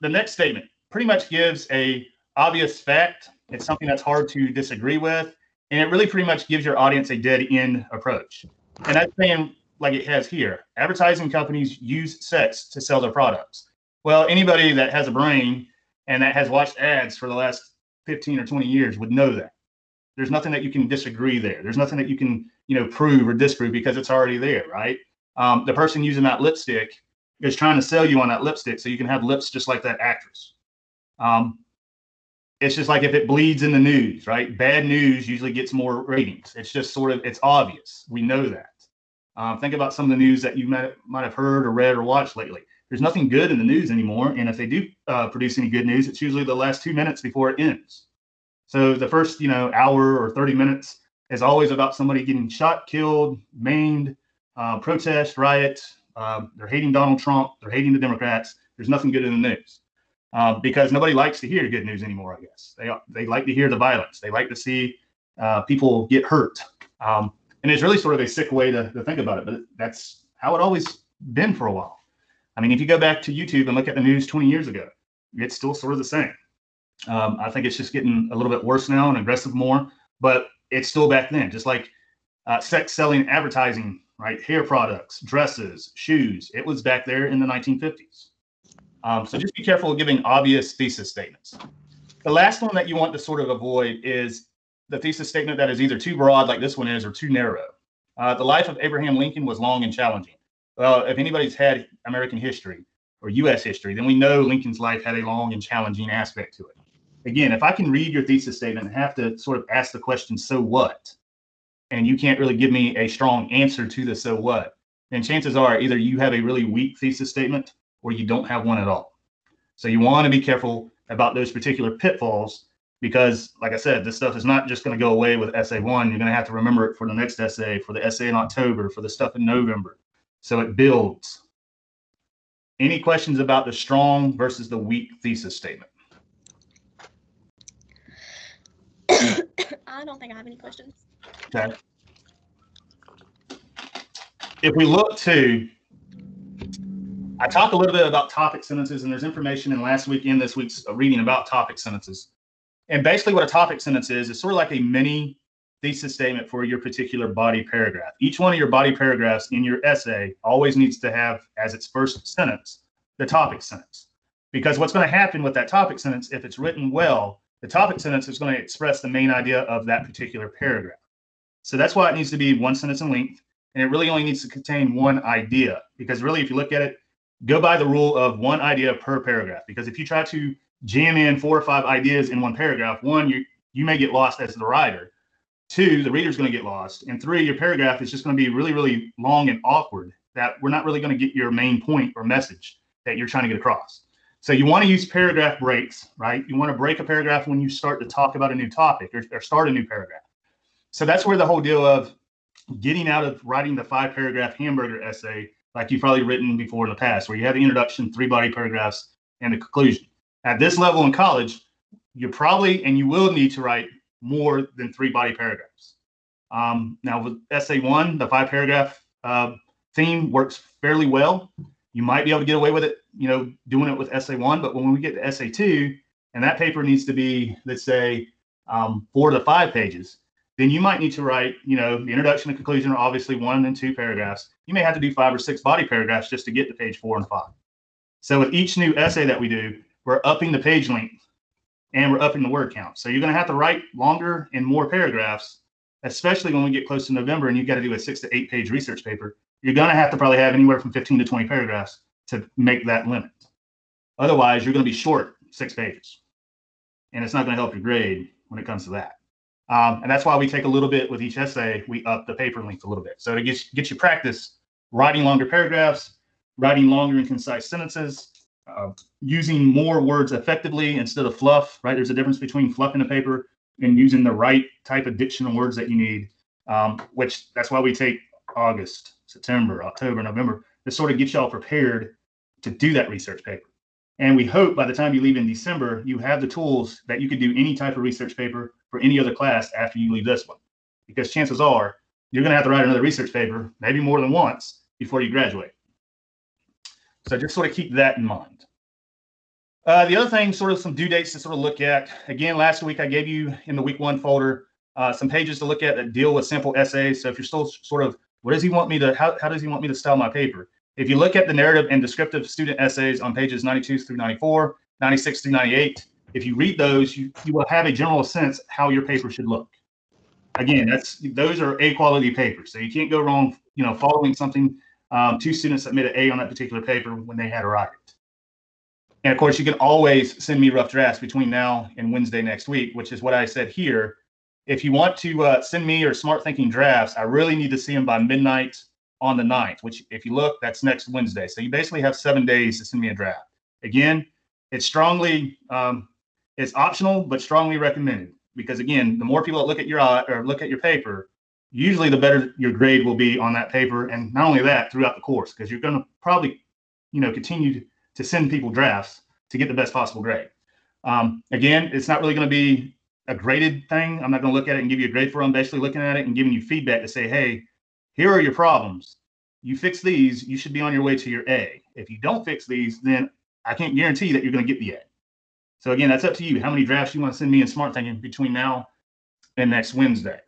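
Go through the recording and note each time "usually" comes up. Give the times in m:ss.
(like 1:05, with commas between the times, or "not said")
0:35, 0:46, 5:51.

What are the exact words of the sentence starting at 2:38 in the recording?
Each one of your body paragraphs in your essay always needs to have as its first sentence the topic sentence.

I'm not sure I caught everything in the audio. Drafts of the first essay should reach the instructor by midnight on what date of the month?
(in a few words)
9th.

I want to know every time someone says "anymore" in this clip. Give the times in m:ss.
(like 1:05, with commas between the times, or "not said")
0:43, 1:02.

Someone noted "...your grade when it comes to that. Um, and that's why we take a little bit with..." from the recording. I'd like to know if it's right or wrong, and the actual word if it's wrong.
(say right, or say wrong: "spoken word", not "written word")
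right.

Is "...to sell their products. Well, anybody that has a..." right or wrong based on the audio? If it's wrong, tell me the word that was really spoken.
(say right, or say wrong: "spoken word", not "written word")
right.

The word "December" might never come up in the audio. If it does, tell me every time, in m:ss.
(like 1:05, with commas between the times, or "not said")
4:45.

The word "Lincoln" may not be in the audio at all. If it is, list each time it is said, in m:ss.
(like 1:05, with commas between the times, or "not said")
1:39, 1:44.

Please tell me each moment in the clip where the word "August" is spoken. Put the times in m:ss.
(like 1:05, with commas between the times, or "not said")
4:38.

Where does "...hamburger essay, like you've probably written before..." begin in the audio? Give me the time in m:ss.
3:24.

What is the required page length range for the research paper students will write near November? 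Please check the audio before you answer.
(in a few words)
6 to 8 pages.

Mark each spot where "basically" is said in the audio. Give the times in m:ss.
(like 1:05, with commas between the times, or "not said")
2:33, 5:41, 6:05.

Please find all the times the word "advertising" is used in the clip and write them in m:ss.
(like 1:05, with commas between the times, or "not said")
0:10, 1:23.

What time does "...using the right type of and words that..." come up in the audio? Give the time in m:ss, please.
4:33.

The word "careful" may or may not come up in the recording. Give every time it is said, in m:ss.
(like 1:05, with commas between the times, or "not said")
1:29, 2:00.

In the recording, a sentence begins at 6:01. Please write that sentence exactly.
Um, again, it's not really going to be a graded thing.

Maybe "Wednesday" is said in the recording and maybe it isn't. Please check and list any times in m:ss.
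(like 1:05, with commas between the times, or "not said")
5:32, 5:41, 6:19.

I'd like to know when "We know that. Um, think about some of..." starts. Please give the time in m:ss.
0:38.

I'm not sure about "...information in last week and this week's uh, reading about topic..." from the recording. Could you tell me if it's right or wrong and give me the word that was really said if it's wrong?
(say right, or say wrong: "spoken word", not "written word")
right.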